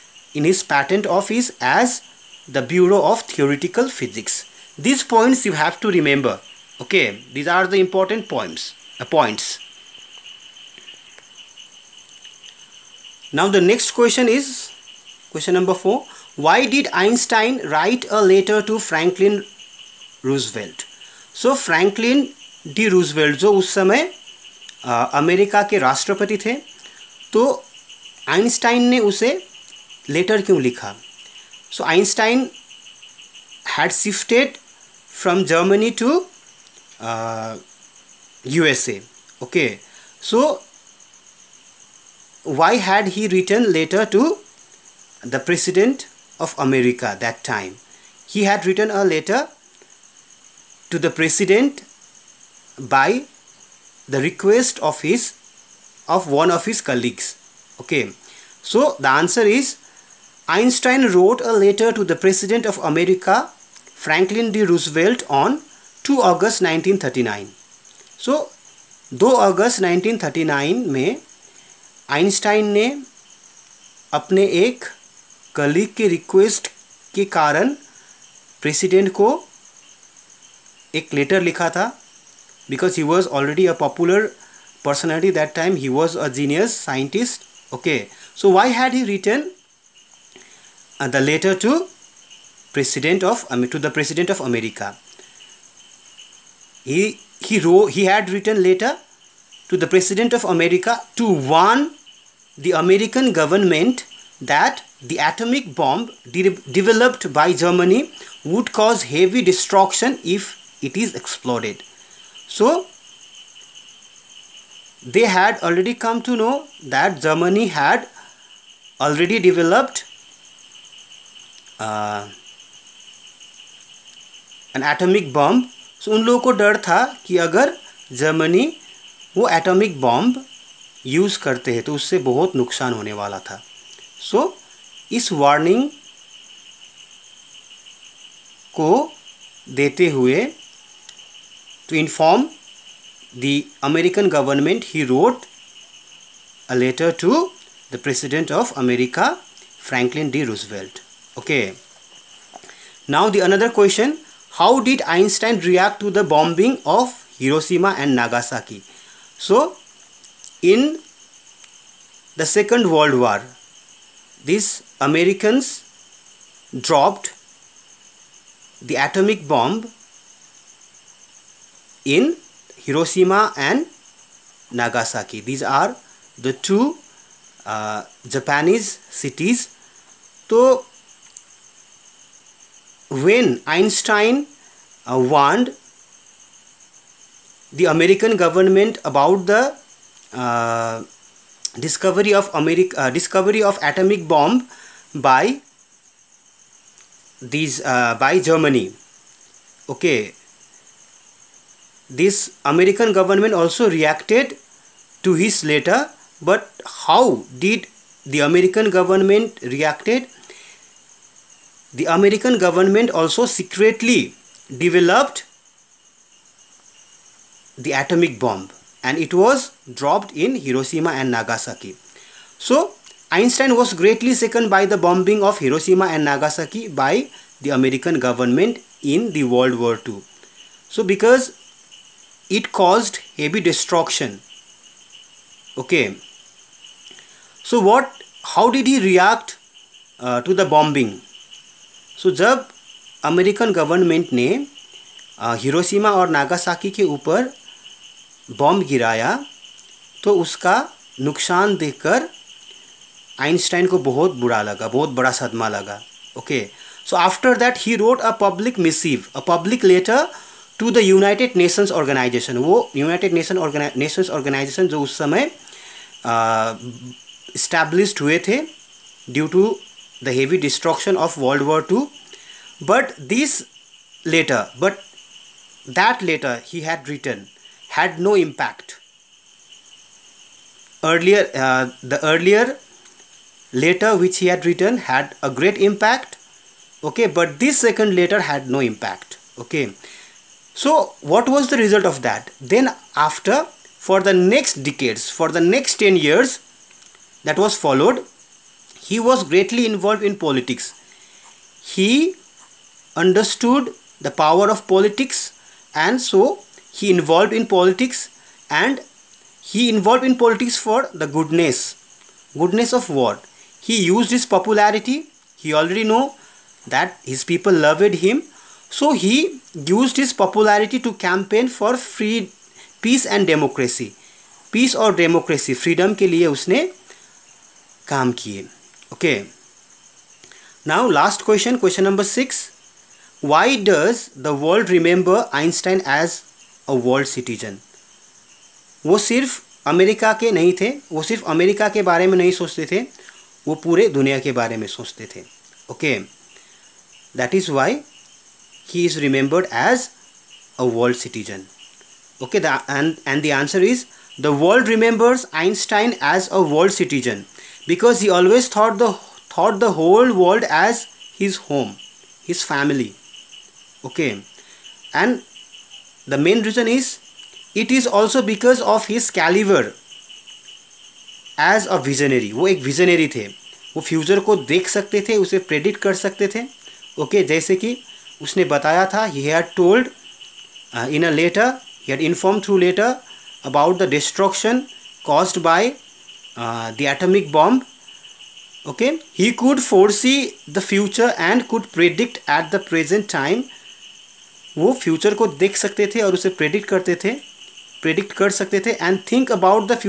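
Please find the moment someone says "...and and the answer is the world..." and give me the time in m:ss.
5:52.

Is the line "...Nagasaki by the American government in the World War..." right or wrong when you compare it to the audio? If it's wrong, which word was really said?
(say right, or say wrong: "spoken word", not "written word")
right.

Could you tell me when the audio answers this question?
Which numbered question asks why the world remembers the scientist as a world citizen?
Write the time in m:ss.
5:31.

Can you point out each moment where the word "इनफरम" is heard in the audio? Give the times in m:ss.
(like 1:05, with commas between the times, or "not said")
6:22.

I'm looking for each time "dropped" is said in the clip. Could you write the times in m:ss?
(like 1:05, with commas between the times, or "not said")
2:46, 3:39.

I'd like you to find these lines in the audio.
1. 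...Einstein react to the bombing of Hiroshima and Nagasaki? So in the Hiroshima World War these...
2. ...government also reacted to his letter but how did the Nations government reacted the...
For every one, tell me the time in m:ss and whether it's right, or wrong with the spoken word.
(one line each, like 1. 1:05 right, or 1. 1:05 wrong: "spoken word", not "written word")
1. 2:35 wrong: "Second", not "Hiroshima"
2. 3:23 wrong: "American", not "Nations".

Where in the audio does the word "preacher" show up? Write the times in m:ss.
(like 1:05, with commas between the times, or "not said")
not said.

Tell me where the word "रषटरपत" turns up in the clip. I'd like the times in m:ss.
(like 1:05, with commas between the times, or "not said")
0:25.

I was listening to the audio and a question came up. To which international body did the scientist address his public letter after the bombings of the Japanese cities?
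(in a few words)
United Nations Organization.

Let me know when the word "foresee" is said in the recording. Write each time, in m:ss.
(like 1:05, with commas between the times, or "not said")
6:29.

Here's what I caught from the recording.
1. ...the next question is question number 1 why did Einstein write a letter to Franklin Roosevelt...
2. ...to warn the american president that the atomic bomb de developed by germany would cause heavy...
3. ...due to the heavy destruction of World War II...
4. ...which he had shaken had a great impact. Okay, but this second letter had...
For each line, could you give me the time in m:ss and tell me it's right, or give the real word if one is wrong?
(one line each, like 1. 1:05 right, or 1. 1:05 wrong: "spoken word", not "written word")
1. 0:13 wrong: "4", not "1"
2. 1:41 wrong: "government", not "president"
3. 4:29 right
4. 4:44 wrong: "written", not "shaken".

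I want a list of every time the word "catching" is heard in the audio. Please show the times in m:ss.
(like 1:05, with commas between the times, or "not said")
not said.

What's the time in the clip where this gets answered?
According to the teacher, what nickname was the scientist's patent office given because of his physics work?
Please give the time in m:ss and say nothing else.
0:02.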